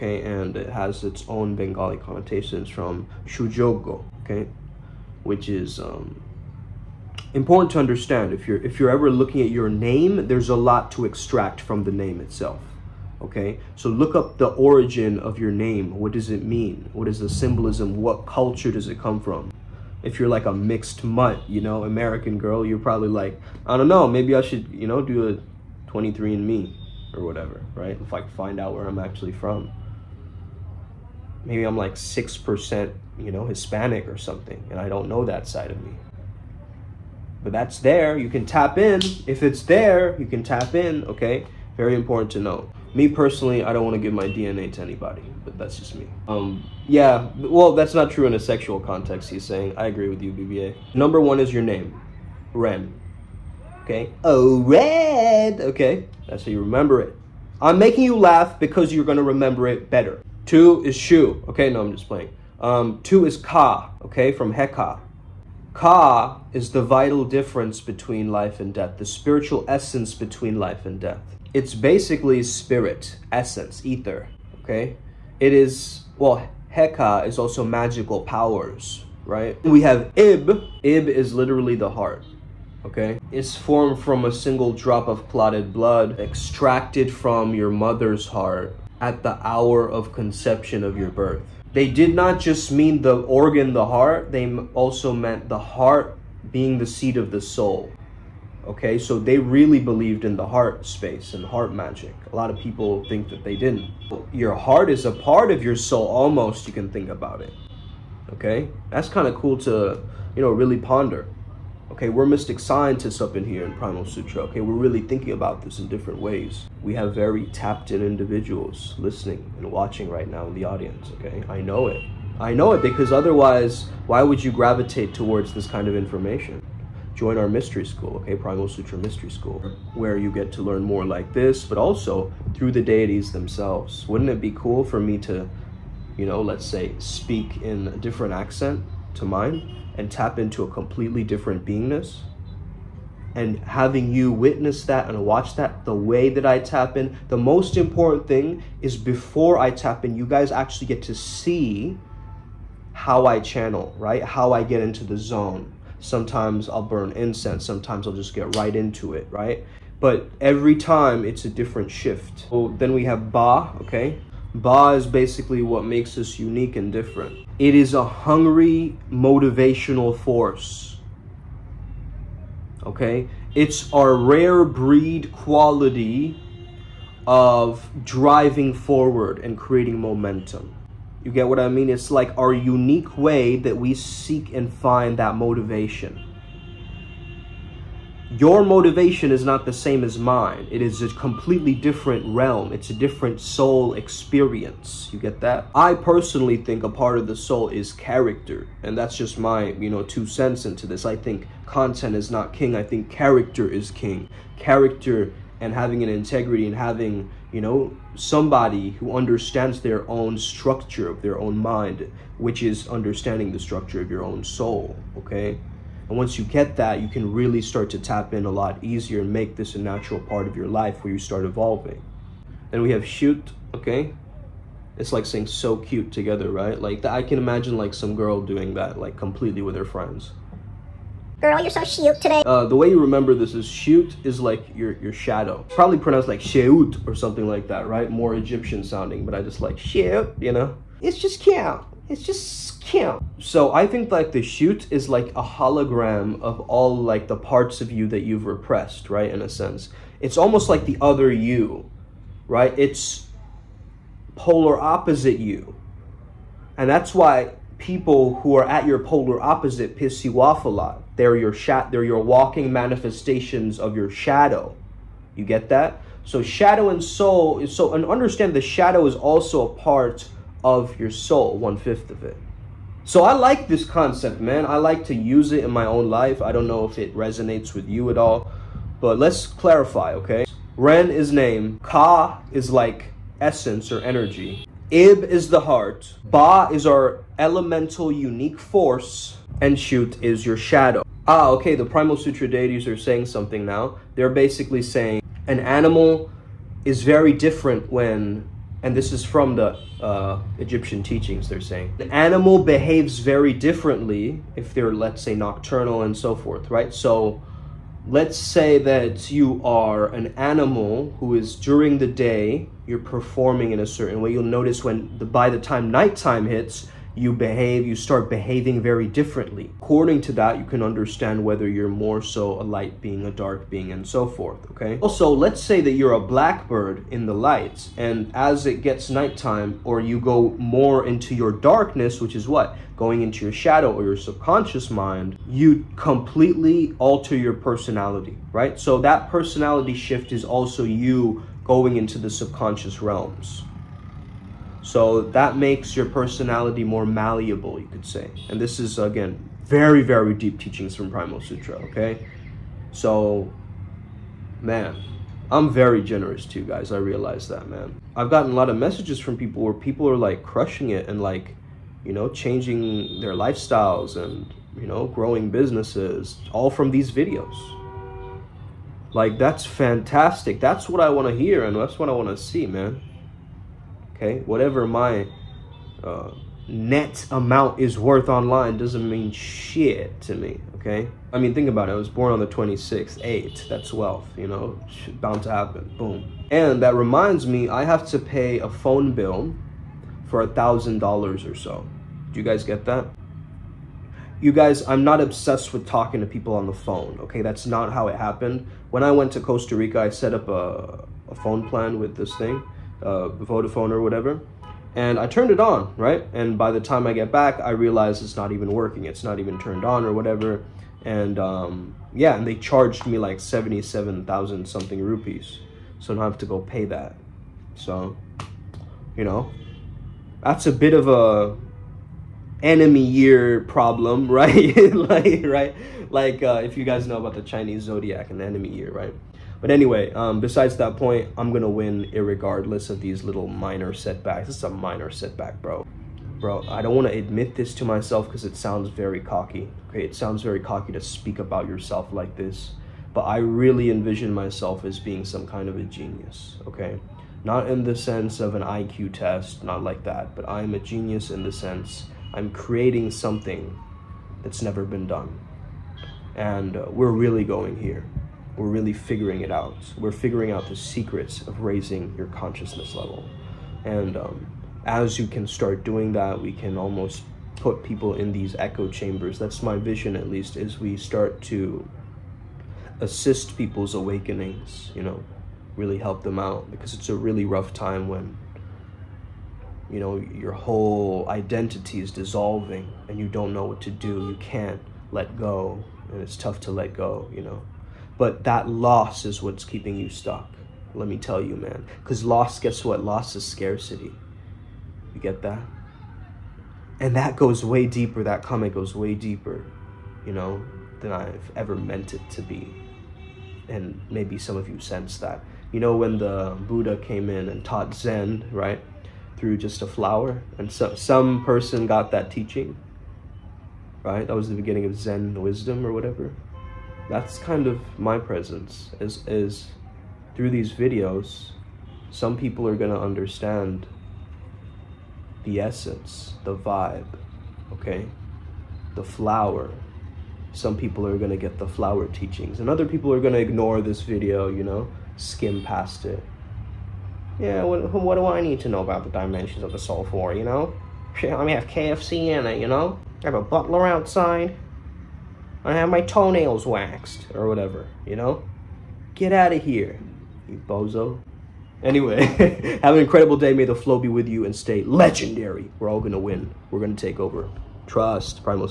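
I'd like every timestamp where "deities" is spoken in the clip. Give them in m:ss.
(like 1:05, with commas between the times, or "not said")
2:12, 4:52.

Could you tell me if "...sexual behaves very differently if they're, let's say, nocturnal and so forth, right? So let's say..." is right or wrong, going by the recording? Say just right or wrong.
wrong.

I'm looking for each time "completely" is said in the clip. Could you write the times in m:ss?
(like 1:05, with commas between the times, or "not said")
2:20, 3:11, 3:49, 5:35.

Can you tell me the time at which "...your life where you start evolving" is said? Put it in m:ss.
3:40.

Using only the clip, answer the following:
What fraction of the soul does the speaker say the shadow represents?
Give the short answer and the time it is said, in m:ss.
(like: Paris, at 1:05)
one fifth, at 4:31.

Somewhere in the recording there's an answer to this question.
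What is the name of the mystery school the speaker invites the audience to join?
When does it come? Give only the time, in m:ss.
2:08.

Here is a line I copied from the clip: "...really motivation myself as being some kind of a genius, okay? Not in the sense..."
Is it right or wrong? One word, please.
wrong.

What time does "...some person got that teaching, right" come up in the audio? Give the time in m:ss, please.
8:30.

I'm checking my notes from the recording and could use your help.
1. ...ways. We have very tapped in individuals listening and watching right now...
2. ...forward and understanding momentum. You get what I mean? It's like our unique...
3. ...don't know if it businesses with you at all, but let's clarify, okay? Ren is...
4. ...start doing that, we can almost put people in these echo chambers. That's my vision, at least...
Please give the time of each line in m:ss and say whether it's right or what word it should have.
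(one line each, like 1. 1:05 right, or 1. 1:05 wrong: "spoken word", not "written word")
1. 1:56 right
2. 2:58 wrong: "creating", not "understanding"
3. 4:36 wrong: "resonates", not "businesses"
4. 7:45 right.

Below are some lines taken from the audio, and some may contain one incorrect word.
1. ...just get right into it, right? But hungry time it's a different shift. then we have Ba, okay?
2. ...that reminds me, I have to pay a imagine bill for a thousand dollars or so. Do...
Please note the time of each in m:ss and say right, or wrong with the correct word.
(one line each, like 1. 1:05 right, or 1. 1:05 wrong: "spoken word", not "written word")
1. 2:38 wrong: "every", not "hungry"
2. 6:26 wrong: "phone", not "imagine".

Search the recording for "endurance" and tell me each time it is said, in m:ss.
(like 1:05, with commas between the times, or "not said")
not said.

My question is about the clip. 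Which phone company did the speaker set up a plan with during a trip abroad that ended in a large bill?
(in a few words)
Vodafone.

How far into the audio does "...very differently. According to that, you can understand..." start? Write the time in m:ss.
5:18.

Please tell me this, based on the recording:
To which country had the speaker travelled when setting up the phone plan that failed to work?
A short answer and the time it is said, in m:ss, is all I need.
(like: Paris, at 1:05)
Costa Rica, at 6:39.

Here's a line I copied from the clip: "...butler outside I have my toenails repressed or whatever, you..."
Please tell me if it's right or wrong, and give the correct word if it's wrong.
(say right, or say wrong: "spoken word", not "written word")
wrong: "waxed", not "repressed".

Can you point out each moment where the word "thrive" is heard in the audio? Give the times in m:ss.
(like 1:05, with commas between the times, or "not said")
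not said.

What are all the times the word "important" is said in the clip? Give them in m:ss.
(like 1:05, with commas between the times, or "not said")
0:07, 0:41, 2:27.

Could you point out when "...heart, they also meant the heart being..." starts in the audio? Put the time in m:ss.
1:33.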